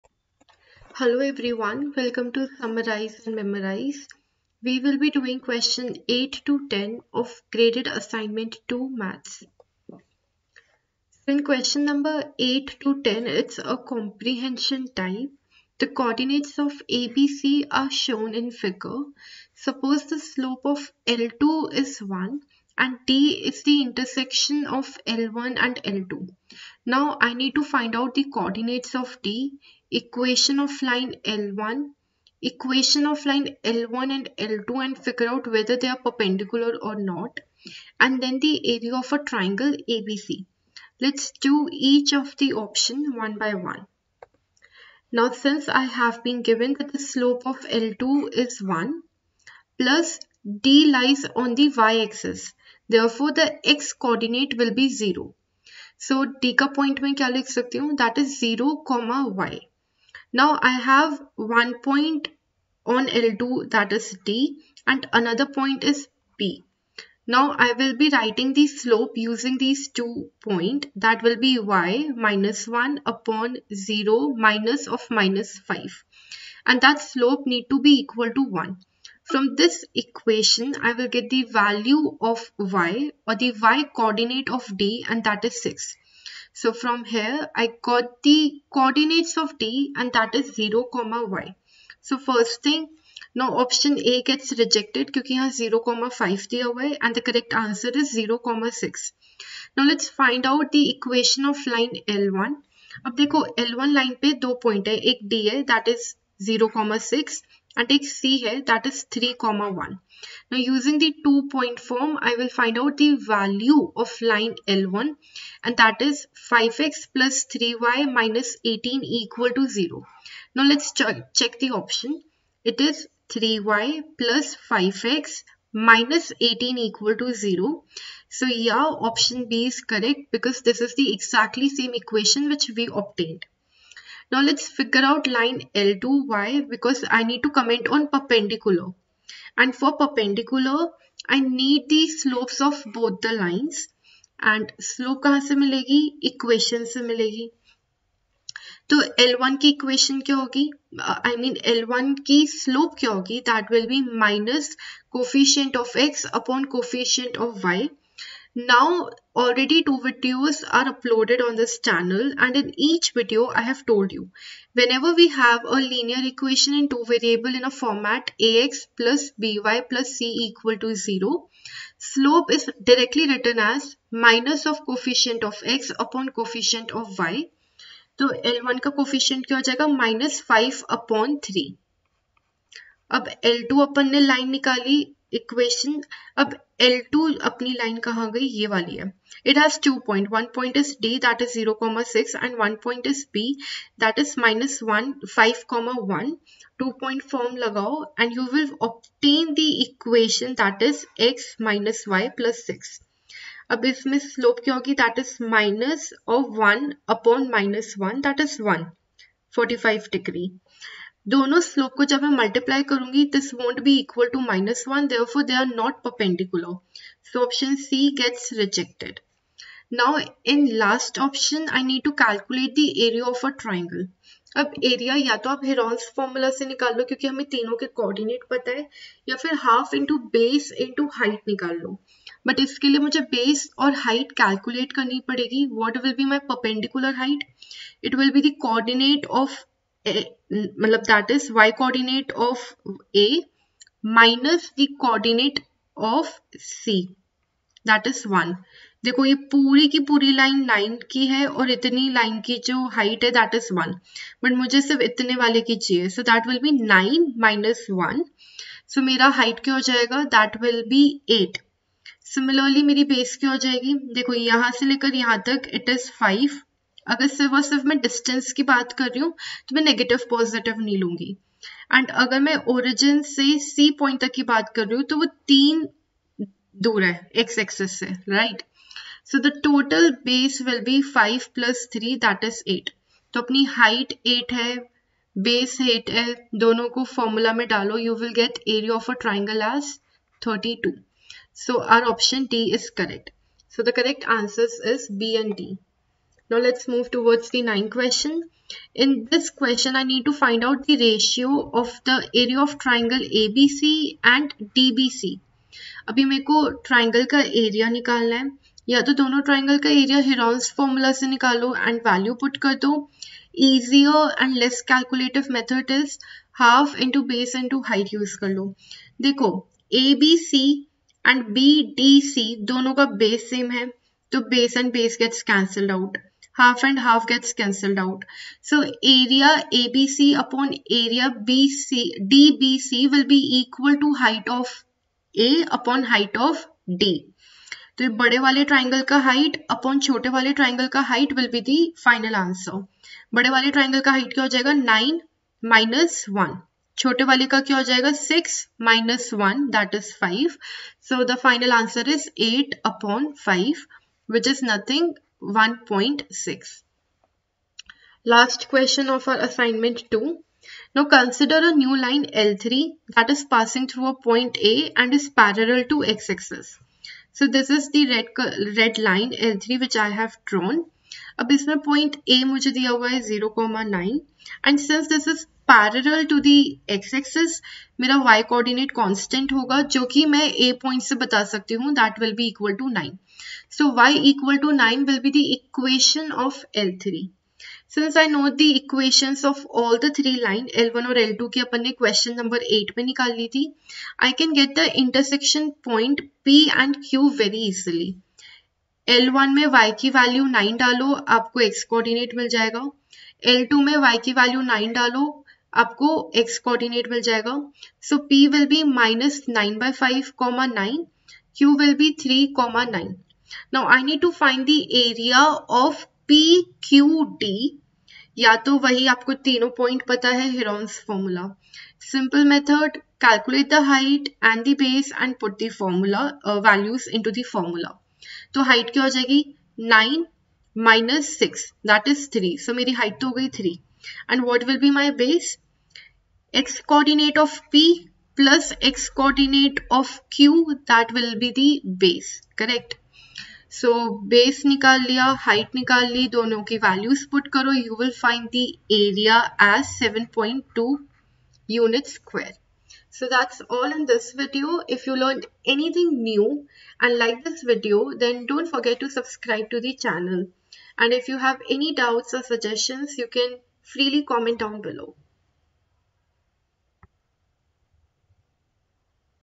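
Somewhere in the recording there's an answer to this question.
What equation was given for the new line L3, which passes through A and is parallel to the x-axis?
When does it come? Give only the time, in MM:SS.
06:23.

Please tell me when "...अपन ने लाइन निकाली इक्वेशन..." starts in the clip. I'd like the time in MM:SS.
03:03.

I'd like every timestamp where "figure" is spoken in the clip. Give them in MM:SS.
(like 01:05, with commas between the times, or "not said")
00:18, 00:34, 02:14.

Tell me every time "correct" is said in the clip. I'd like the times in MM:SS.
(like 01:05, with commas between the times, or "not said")
01:37, 02:09, 07:22.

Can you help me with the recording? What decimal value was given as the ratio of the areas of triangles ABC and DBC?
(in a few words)
1.6.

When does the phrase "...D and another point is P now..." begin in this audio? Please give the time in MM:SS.
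01:04.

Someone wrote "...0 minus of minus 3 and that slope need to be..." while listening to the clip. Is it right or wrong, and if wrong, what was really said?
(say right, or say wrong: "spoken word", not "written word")
wrong: "5", not "3".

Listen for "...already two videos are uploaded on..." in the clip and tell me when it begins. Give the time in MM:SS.
02:39.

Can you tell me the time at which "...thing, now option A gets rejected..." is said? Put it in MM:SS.
01:32.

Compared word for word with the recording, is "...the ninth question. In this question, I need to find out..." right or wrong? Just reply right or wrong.
right.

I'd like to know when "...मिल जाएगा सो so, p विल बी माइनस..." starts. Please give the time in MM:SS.
06:47.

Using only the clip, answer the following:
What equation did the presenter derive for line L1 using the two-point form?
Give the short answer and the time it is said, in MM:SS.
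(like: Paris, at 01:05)
5x + 3y - 18 = 0, at 01:56.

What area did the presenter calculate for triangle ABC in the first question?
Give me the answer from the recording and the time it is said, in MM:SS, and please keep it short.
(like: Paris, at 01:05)
32, at 04:50.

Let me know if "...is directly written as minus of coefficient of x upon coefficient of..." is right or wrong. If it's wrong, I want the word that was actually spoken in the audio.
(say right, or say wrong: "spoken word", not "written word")
right.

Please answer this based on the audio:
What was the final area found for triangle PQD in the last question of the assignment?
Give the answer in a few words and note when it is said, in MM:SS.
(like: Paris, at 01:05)
7.2 square units, at 07:29.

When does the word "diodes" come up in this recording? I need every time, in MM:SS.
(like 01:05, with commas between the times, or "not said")
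not said.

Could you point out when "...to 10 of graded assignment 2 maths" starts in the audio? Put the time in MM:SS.
00:06.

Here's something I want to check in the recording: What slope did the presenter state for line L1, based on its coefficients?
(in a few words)
-5/3.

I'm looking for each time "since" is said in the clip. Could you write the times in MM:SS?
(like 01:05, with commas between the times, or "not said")
00:45, 06:14.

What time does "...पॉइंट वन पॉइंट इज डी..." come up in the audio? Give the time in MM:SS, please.
03:10.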